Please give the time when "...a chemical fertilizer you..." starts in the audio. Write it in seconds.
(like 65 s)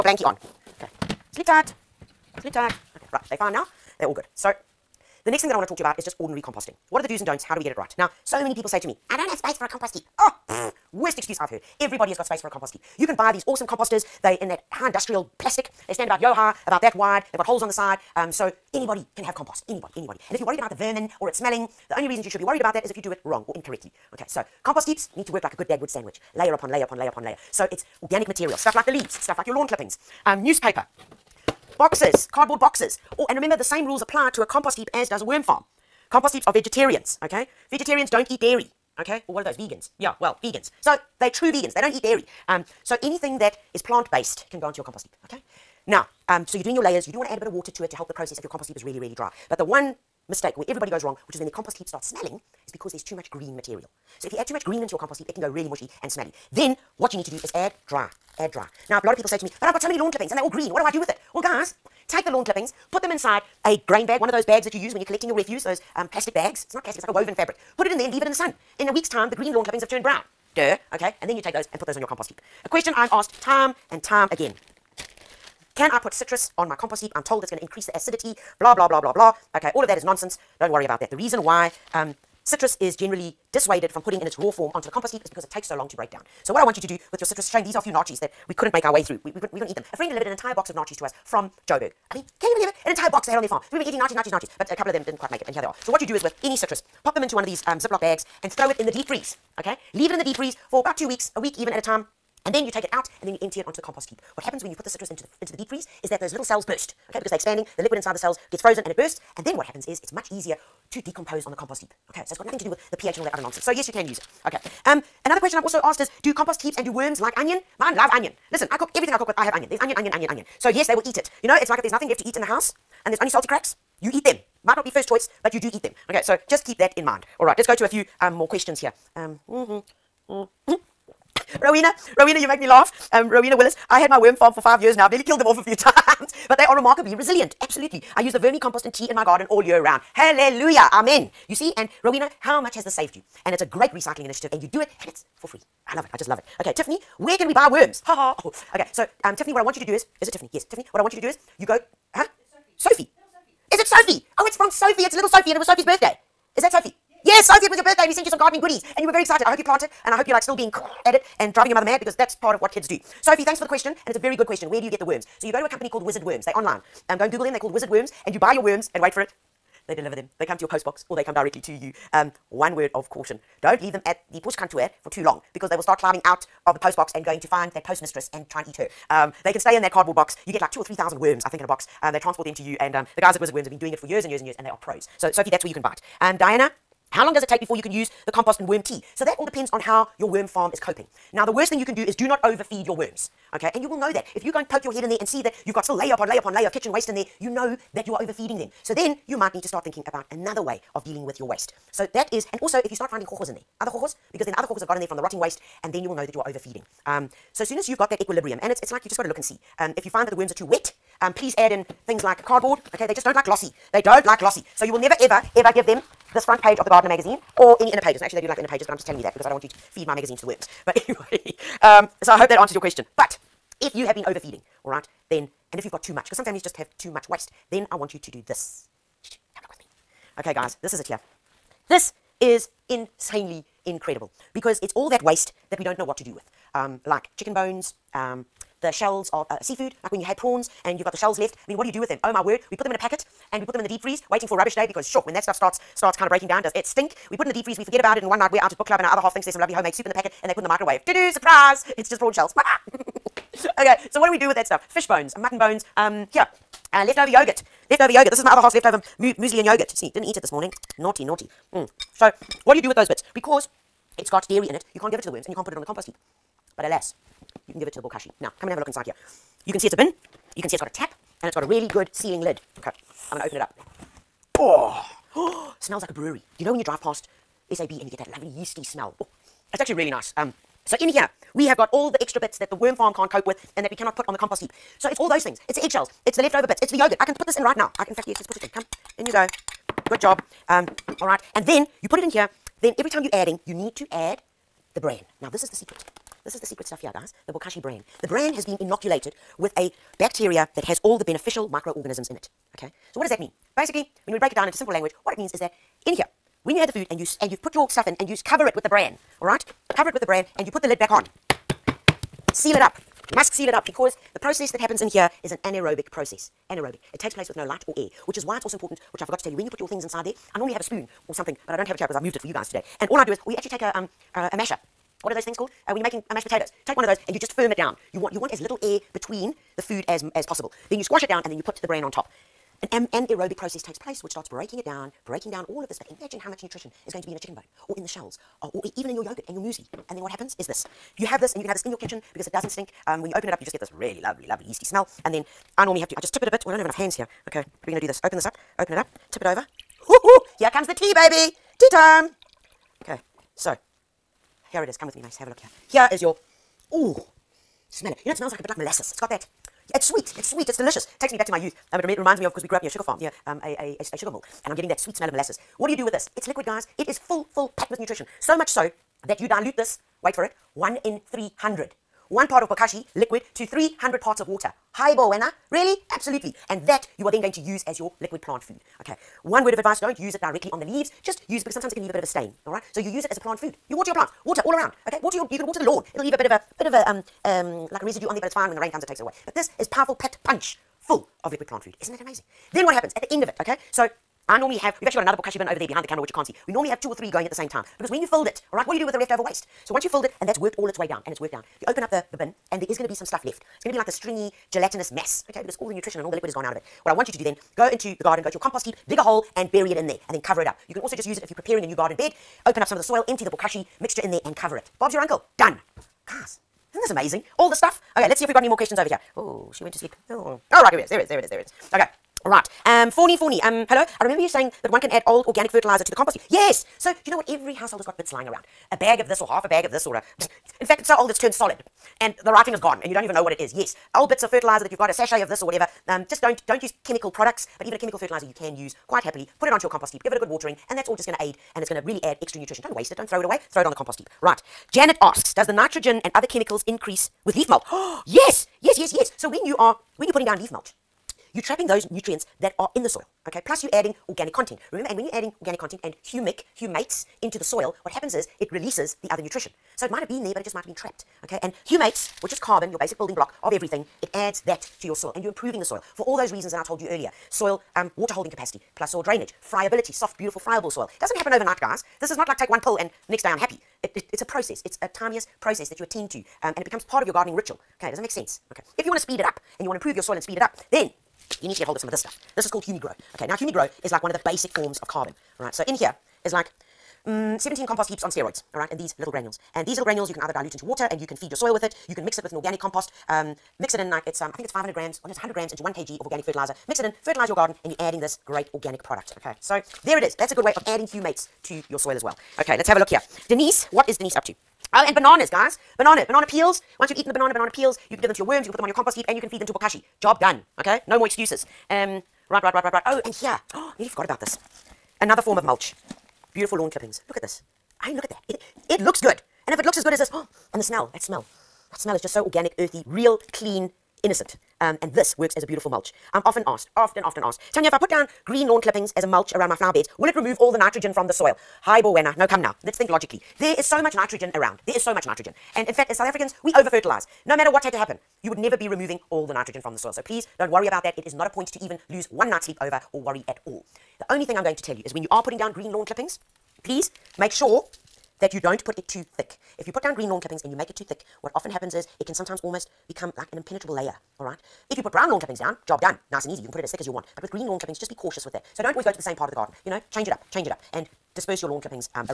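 437 s.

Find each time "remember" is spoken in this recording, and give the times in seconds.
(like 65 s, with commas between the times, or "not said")
33 s, 424 s, 454 s.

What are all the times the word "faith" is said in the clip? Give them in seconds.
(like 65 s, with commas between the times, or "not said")
not said.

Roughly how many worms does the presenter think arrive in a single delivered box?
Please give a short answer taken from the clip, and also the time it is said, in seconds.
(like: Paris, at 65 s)
2 or 3 thousand, at 180 s.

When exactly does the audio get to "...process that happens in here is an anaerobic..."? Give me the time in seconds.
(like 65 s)
314 s.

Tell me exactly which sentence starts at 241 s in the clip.
I mean, what do you do with them?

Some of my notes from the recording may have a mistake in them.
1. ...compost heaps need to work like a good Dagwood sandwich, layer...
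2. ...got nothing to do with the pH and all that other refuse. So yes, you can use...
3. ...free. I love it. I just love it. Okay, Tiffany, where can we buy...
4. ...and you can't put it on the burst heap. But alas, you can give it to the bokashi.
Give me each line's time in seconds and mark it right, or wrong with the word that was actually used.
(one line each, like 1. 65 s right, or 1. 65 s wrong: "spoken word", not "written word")
1. 24 s right
2. 112 s wrong: "nonsense", not "refuse"
3. 145 s right
4. 265 s wrong: "compost", not "burst".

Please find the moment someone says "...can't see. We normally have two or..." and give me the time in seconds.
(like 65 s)
396 s.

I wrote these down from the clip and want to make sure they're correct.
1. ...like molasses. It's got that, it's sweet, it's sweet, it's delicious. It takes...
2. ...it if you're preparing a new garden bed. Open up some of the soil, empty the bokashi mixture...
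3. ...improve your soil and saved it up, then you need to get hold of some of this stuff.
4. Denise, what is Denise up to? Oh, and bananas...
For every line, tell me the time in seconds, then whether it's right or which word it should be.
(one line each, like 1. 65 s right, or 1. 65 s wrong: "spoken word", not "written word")
1. 358 s right
2. 411 s right
3. 479 s wrong: "speed", not "saved"
4. 503 s right.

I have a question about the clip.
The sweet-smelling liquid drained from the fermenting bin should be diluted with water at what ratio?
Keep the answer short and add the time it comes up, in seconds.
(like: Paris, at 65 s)
1 in 300, at 370 s.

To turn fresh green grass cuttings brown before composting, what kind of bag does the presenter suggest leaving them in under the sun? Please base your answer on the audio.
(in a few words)
grain bag.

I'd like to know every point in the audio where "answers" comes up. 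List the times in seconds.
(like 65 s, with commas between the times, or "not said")
222 s.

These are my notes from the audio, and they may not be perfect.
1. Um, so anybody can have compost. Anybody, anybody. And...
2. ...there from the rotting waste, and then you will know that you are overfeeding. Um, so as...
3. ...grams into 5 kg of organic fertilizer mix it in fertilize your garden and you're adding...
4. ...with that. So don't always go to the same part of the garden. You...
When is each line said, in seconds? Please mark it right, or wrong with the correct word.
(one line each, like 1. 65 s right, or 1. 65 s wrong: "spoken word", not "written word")
1. 18 s right
2. 204 s right
3. 495 s wrong: "1", not "5"
4. 558 s right.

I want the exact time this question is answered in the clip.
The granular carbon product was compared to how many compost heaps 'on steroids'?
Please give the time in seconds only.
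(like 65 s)
487 s.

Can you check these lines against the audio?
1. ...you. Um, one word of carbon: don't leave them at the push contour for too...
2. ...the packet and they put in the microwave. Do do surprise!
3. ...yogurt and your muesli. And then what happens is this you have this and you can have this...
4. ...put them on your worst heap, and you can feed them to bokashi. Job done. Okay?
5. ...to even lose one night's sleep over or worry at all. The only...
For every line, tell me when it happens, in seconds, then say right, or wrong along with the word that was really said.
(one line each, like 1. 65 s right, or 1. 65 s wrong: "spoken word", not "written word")
1. 171 s wrong: "caution", not "carbon"
2. 250 s right
3. 339 s right
4. 508 s wrong: "compost", not "worst"
5. 541 s right.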